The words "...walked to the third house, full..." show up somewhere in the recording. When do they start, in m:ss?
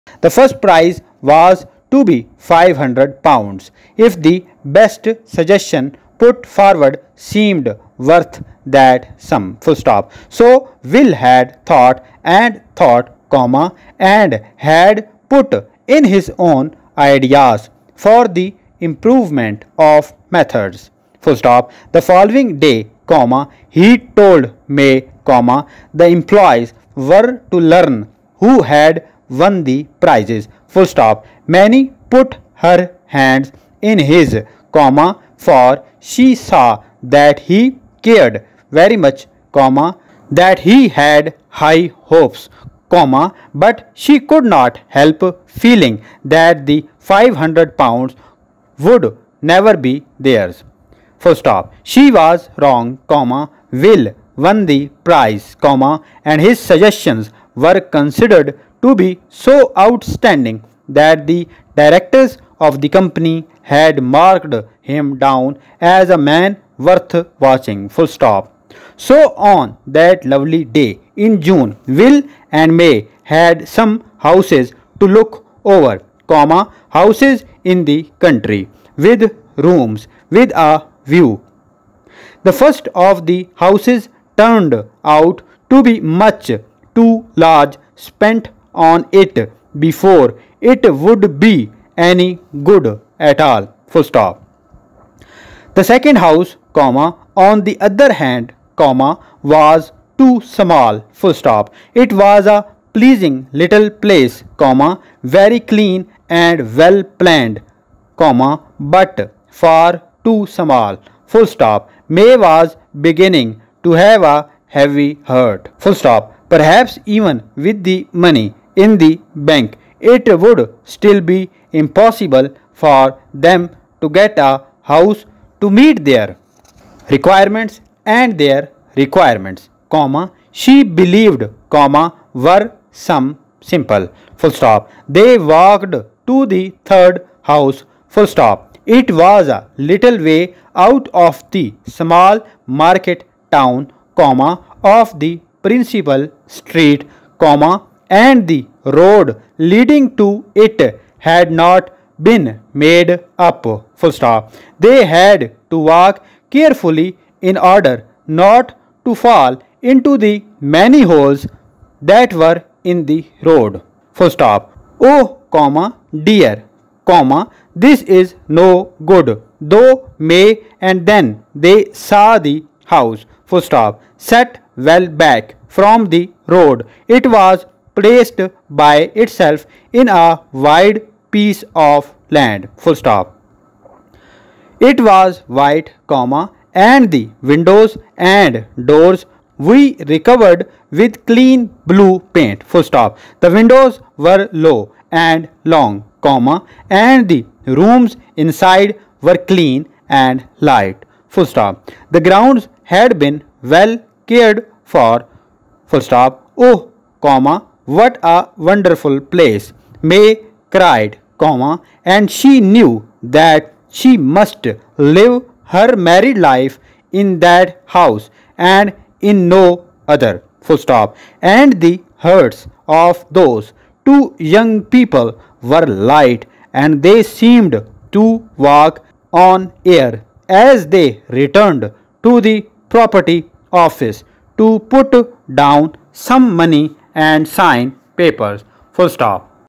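2:15.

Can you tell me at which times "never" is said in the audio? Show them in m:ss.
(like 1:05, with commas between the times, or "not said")
0:49.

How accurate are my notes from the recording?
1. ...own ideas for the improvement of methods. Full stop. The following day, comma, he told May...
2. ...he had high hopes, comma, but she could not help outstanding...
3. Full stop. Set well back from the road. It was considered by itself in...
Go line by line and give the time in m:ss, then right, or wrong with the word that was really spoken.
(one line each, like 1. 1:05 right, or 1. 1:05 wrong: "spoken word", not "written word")
1. 0:16 right
2. 0:40 wrong: "feeling", not "outstanding"
3. 2:53 wrong: "placed", not "considered".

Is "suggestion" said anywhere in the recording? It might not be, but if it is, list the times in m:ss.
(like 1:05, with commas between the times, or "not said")
0:05, 0:56.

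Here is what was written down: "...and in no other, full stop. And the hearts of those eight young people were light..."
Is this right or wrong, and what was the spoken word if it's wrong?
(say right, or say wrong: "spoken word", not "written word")
wrong: "two", not "eight".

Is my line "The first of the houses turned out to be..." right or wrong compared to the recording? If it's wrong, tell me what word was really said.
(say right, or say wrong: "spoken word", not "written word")
right.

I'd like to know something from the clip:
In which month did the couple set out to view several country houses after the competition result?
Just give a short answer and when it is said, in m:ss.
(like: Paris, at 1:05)
June, at 1:11.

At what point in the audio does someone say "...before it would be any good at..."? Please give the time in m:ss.
1:29.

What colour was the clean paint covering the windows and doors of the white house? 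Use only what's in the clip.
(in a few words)
blue.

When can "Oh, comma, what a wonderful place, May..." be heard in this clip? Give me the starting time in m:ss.
3:26.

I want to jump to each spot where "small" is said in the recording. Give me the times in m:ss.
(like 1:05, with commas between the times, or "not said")
1:40, 1:50, 2:21.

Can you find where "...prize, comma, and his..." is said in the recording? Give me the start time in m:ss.
0:55.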